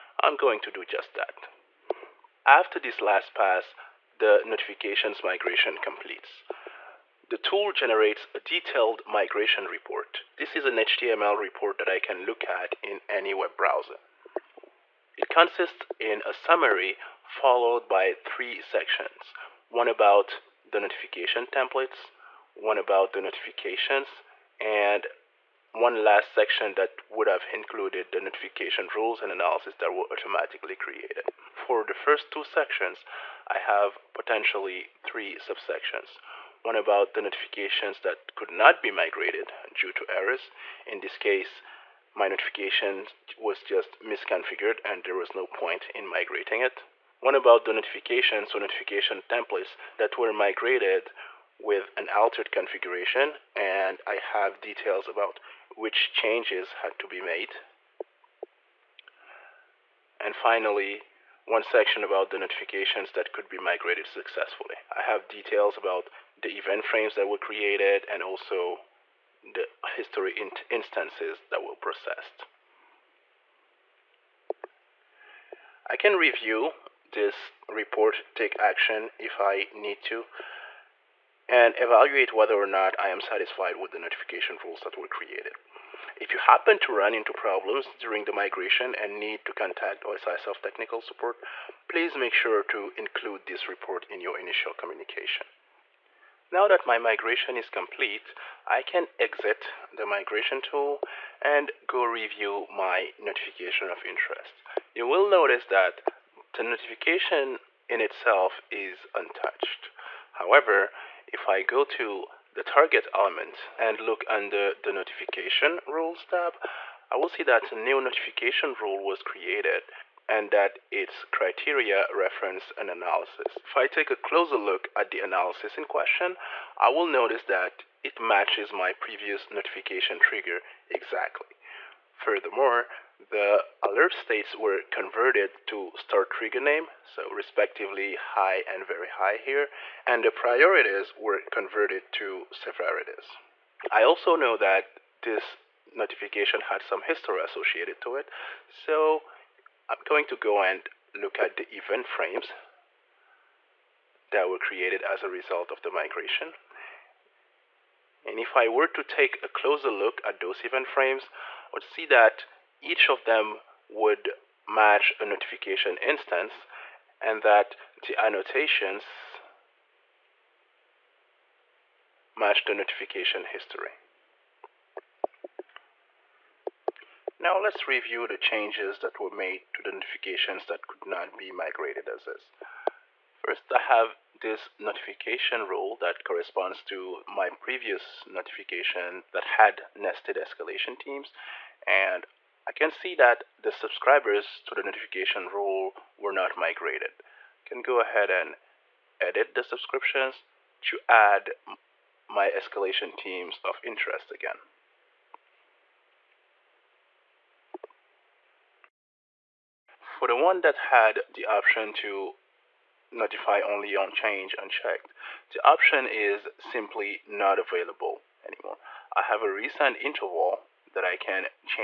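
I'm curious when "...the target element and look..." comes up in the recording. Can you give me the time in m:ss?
1:52.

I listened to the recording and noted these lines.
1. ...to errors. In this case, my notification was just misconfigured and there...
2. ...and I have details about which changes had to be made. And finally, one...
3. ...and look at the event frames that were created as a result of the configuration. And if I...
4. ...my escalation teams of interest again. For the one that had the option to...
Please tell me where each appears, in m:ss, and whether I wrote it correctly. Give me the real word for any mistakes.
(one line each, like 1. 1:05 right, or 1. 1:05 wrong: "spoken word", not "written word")
1. 0:39 right
2. 0:53 right
3. 2:30 wrong: "migration", not "configuration"
4. 3:22 right.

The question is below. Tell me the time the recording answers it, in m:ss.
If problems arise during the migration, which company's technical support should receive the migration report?
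1:30.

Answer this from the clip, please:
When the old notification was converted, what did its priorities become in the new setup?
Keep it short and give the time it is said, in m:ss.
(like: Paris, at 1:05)
severities, at 2:22.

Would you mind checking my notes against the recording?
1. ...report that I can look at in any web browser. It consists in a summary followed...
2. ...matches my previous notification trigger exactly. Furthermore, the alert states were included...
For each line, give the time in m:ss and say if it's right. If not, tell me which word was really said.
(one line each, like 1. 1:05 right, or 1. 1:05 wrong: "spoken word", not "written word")
1. 0:11 right
2. 2:08 wrong: "converted", not "included".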